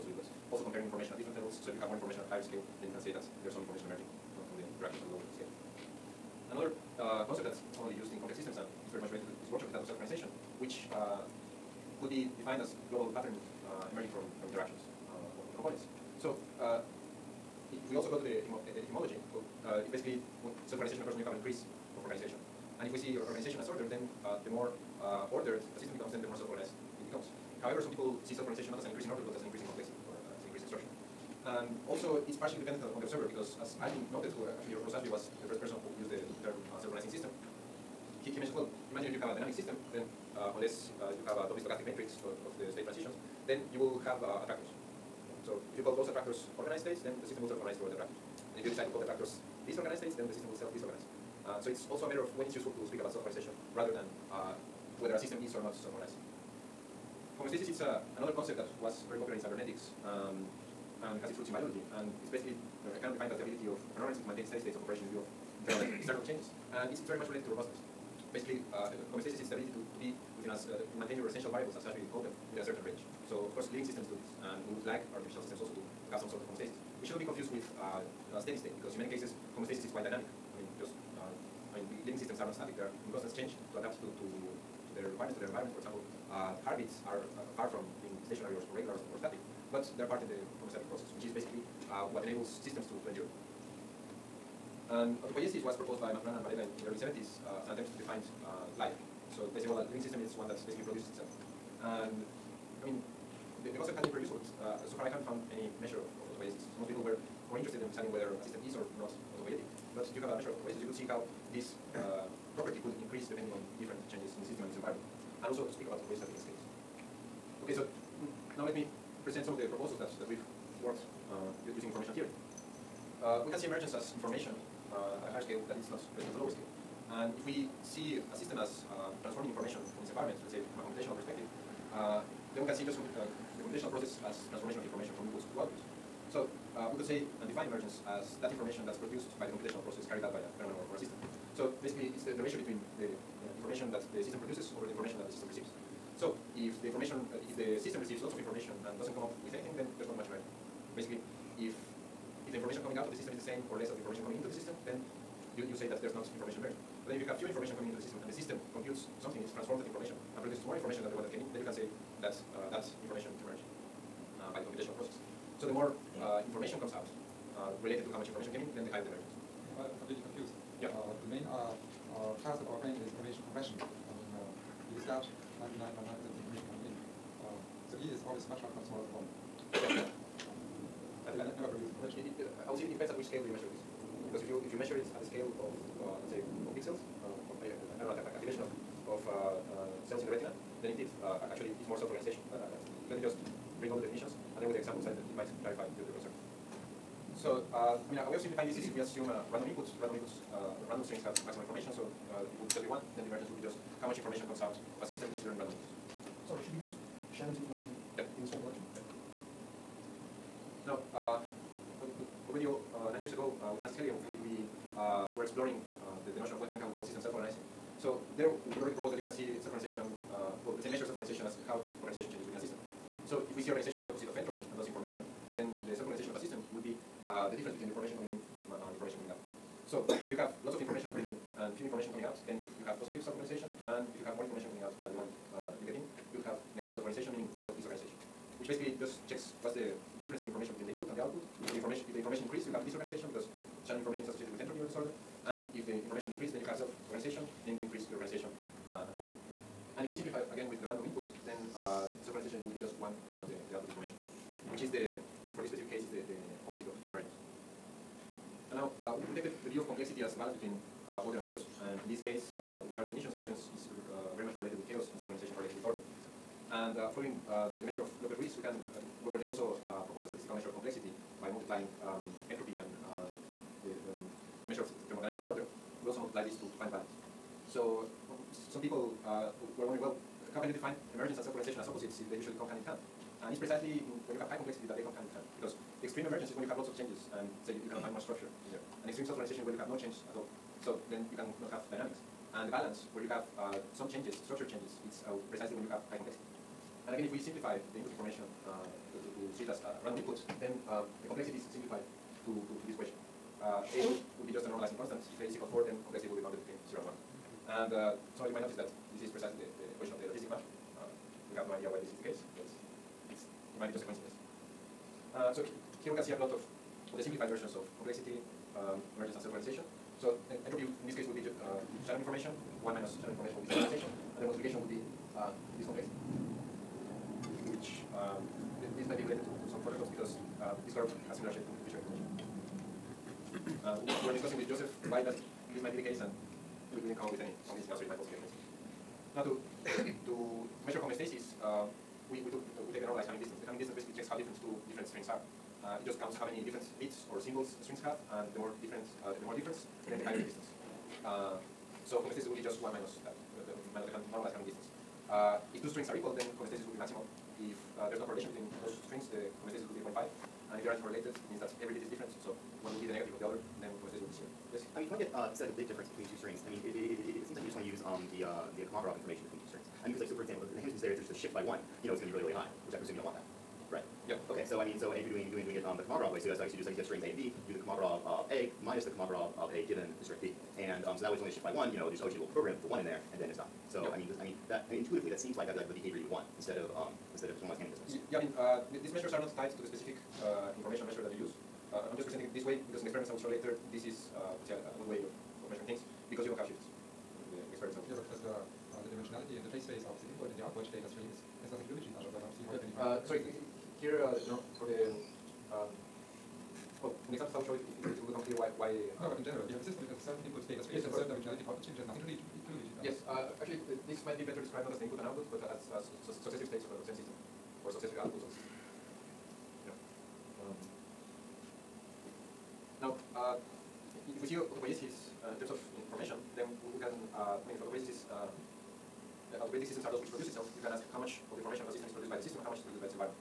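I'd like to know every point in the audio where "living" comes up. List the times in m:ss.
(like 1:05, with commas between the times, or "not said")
1:13, 1:22, 1:39.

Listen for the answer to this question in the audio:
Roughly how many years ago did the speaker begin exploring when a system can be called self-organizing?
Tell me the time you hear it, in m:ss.
3:33.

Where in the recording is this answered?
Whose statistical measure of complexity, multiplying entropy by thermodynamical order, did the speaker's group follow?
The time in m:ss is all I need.
4:28.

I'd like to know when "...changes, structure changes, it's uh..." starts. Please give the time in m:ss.
4:54.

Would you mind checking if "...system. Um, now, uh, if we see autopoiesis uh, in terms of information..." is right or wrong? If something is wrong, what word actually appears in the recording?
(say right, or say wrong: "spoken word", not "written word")
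right.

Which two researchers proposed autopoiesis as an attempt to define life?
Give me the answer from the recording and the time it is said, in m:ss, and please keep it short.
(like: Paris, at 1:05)
Maturana and Varela, at 1:36.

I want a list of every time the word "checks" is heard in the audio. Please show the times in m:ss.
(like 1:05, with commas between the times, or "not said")
3:59, 5:44.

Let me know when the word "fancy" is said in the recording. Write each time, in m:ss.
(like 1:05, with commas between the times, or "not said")
not said.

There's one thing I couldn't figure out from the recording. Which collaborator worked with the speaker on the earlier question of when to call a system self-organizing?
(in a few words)
Francis Heylighen.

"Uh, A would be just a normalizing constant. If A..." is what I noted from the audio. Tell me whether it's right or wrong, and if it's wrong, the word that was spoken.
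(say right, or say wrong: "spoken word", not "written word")
right.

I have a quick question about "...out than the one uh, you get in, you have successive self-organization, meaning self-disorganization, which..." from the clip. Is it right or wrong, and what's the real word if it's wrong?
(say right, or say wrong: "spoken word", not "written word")
wrong: "negative", not "successive".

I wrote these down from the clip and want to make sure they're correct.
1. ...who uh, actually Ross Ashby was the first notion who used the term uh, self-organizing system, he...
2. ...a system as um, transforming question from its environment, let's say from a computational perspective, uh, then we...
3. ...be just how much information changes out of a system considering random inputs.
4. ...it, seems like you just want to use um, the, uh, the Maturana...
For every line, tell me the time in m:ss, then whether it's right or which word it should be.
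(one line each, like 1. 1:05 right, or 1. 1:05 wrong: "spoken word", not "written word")
1. 0:34 wrong: "person", not "notion"
2. 2:08 wrong: "information", not "question"
3. 3:23 wrong: "comes", not "changes"
4. 6:07 wrong: "Kolmogorov", not "Maturana".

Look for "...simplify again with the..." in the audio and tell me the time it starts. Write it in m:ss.
4:10.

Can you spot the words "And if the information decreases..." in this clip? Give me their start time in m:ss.
4:05.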